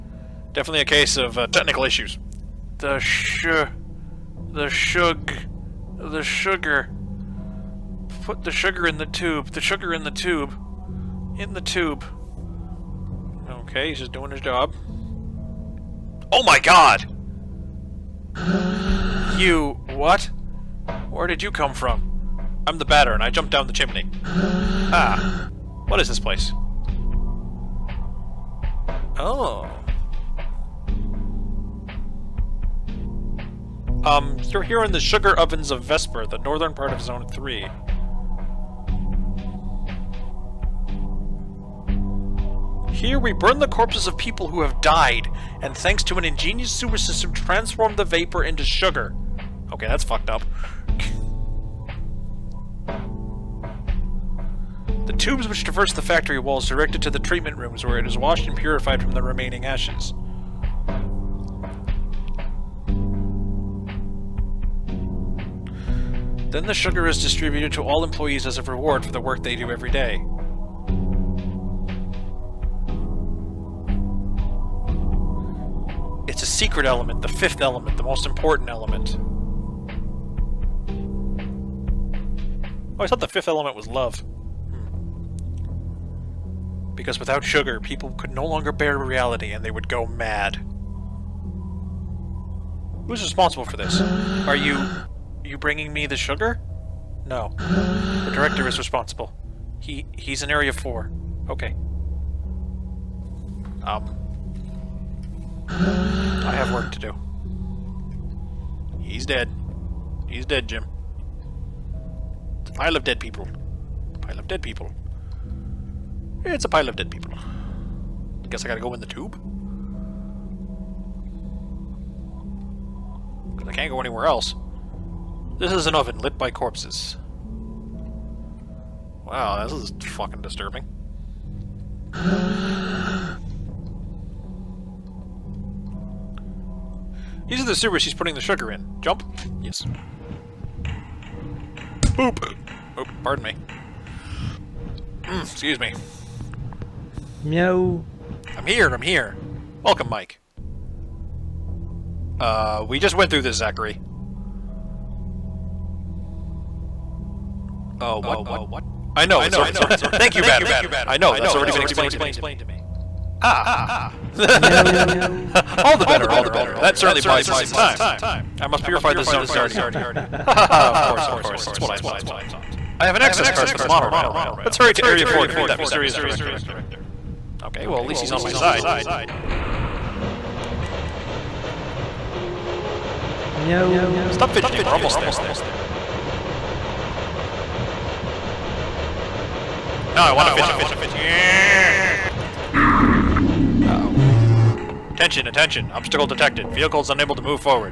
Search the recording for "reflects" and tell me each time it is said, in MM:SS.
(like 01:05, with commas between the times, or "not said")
not said.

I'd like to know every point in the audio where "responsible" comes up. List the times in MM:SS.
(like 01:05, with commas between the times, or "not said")
01:33, 01:38.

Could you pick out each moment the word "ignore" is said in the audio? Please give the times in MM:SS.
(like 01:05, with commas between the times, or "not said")
not said.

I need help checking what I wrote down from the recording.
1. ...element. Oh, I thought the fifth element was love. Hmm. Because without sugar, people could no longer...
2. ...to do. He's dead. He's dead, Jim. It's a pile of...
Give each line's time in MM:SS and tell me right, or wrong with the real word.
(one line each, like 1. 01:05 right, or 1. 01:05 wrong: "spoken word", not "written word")
1. 01:18 right
2. 01:46 right.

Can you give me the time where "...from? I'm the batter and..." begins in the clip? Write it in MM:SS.
00:21.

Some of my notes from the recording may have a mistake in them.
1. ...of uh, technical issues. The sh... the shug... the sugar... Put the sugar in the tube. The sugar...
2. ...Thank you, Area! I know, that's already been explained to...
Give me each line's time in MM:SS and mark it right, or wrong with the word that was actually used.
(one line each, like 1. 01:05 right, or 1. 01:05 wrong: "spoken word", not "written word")
1. 00:01 right
2. 02:40 wrong: "Batter", not "Area".